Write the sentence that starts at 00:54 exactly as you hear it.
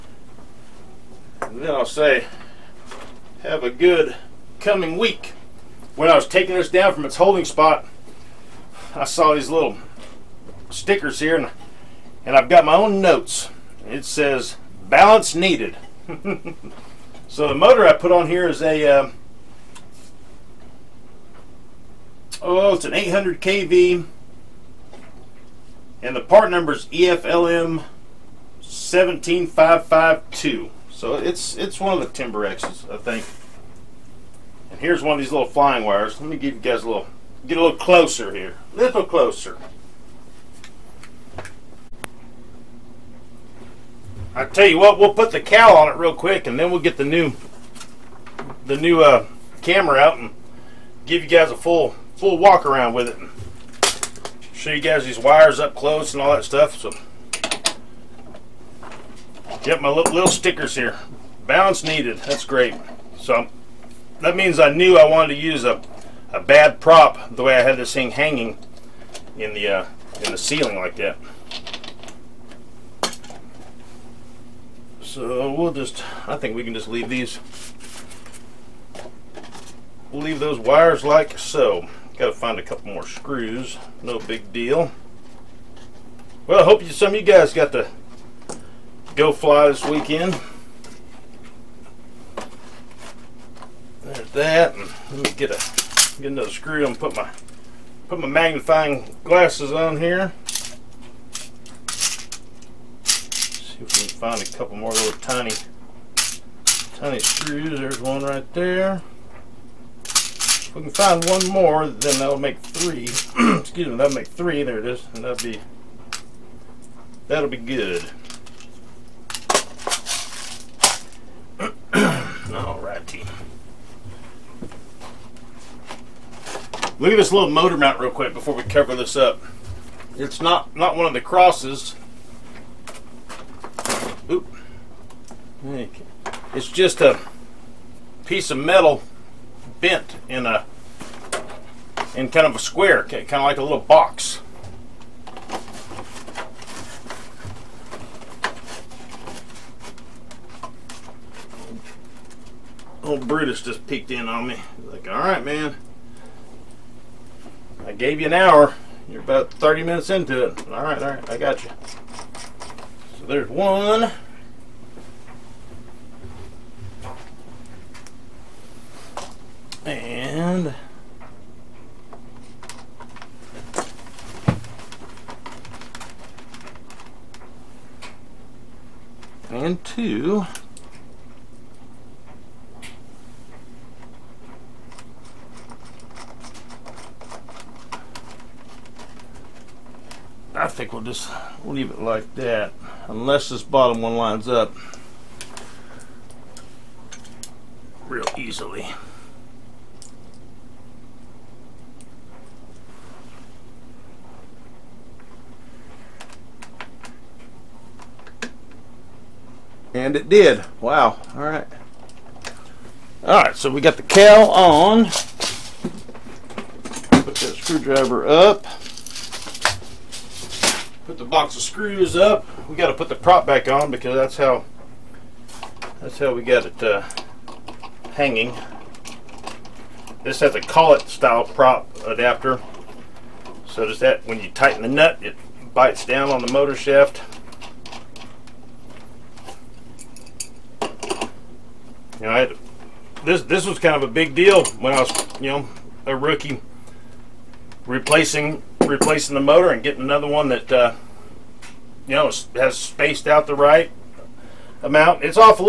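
Show you guys these wires up close and all that stuff.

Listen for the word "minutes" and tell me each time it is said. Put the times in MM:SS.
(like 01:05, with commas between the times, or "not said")
02:39.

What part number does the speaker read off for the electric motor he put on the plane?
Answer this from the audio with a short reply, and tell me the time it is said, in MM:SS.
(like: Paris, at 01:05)
EFLM 17552, at 00:26.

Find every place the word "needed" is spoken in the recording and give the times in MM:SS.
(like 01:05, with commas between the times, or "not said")
00:15, 01:01.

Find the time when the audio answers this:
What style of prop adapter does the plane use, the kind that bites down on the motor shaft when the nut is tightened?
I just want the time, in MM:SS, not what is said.
03:50.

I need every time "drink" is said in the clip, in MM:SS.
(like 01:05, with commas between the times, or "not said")
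not said.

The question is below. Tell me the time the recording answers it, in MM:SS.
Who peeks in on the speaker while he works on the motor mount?
02:33.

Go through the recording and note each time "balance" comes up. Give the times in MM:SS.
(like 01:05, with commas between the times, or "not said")
00:14, 01:01.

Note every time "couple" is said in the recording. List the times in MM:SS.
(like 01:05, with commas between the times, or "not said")
01:22, 01:44.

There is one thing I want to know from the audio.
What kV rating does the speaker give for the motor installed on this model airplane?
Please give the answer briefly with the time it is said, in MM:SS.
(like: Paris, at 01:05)
800 kV, at 00:22.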